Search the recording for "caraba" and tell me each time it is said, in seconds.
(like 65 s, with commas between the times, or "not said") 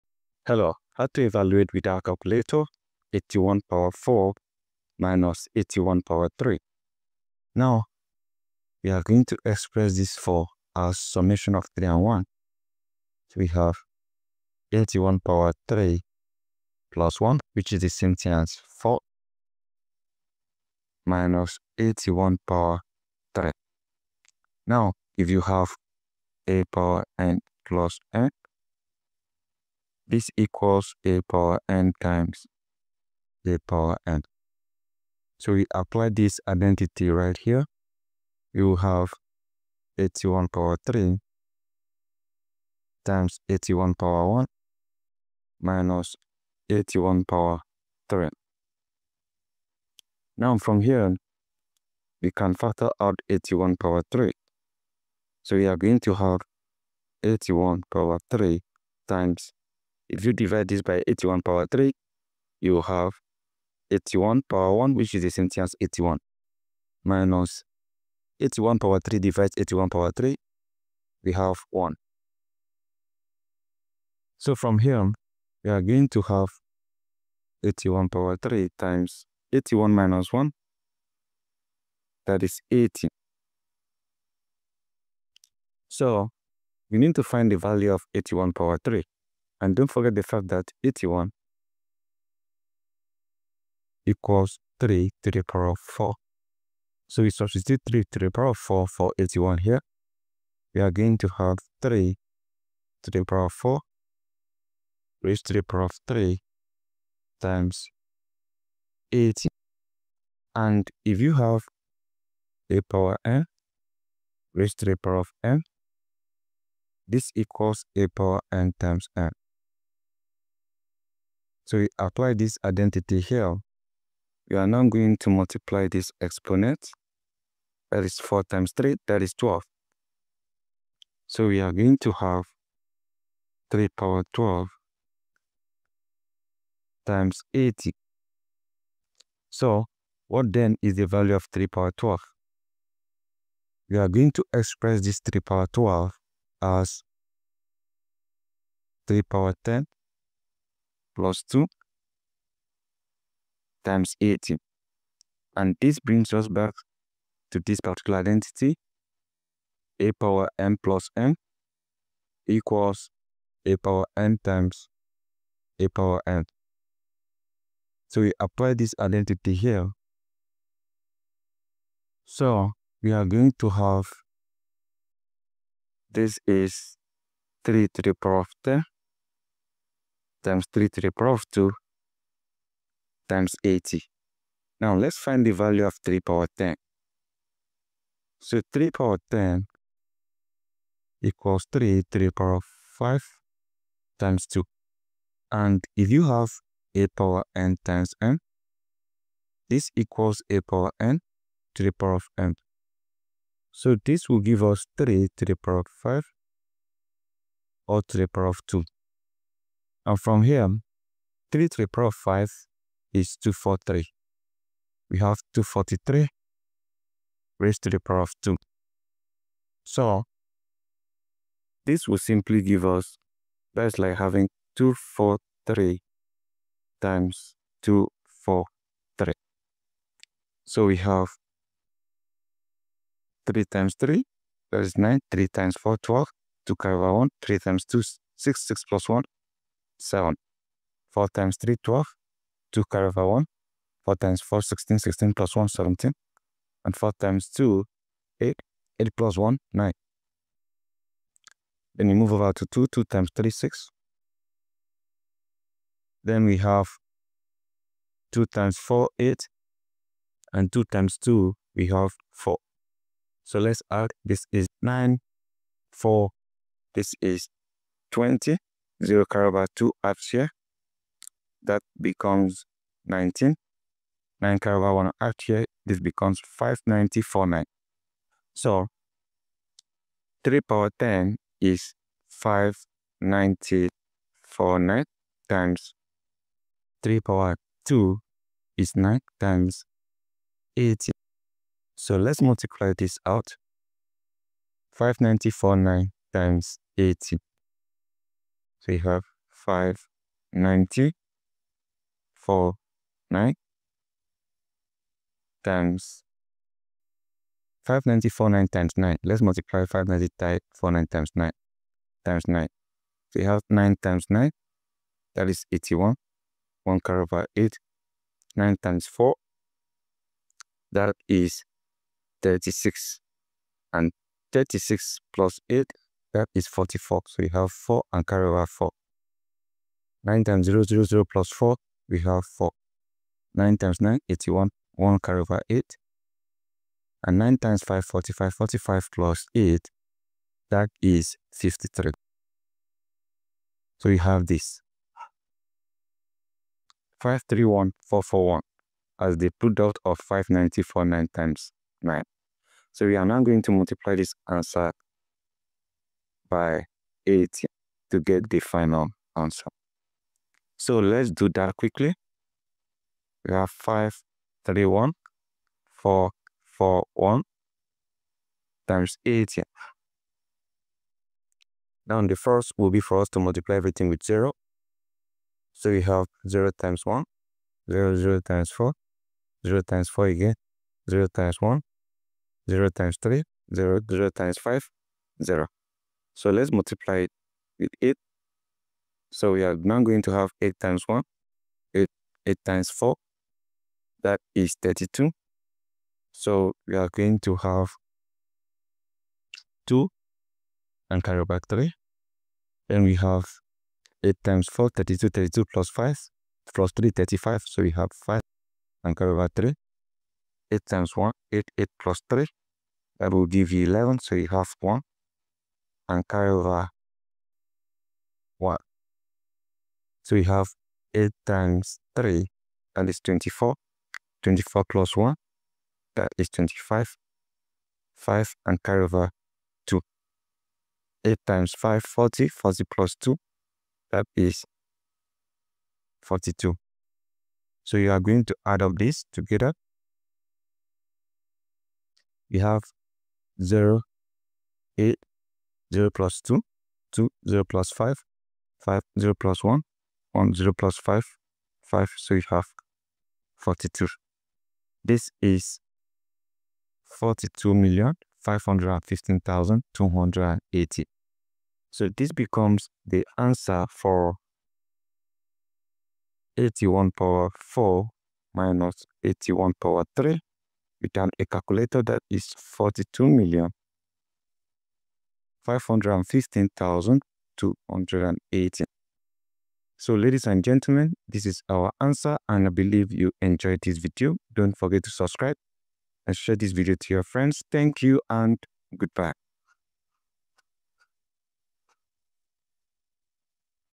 269 s.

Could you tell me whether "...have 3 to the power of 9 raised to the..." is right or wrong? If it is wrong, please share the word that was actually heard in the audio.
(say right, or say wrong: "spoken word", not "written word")
wrong: "4", not "9".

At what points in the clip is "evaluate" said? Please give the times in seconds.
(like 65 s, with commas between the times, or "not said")
1 s.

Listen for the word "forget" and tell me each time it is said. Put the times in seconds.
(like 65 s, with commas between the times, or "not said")
89 s, 484 s.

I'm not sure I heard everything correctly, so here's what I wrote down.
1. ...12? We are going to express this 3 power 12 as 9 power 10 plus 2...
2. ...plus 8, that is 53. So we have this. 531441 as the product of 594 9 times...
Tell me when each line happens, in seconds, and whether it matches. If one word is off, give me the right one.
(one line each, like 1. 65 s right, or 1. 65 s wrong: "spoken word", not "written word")
1. 141 s wrong: "3", not "9"
2. 339 s right.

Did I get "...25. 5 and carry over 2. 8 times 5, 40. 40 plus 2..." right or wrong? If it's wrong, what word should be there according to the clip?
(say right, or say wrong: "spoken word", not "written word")
right.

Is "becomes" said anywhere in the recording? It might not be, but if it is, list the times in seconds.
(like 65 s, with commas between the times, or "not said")
271 s, 275 s.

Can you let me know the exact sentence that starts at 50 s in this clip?
Now from here, we can factor out 81 power 3.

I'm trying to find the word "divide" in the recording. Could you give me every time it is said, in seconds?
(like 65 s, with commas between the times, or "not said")
60 s, 69 s.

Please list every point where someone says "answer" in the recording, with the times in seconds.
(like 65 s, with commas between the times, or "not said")
354 s, 359 s, 482 s.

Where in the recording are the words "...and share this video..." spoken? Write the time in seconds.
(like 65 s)
486 s.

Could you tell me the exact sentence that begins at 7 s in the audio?
Now, we are going to express this for our summation of 3 and 1.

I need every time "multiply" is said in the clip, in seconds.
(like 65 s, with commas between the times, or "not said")
125 s, 292 s, 353 s, 373 s, 386 s.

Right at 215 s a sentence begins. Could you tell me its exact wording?
We have 243 raised to the power of 2.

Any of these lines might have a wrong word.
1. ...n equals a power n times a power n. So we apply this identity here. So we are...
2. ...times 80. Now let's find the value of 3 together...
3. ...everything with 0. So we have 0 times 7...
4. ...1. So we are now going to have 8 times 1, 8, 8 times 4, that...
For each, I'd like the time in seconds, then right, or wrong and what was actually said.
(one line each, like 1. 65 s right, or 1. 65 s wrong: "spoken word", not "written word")
1. 161 s right
2. 183 s wrong: "power", not "together"
3. 373 s wrong: "1", not "7"
4. 388 s wrong: "8", not "1".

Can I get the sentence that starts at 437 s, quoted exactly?
So you are going to add up this together.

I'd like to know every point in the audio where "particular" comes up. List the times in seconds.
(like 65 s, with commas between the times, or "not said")
157 s.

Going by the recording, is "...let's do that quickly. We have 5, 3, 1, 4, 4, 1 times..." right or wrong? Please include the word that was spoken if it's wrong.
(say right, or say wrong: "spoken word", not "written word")
right.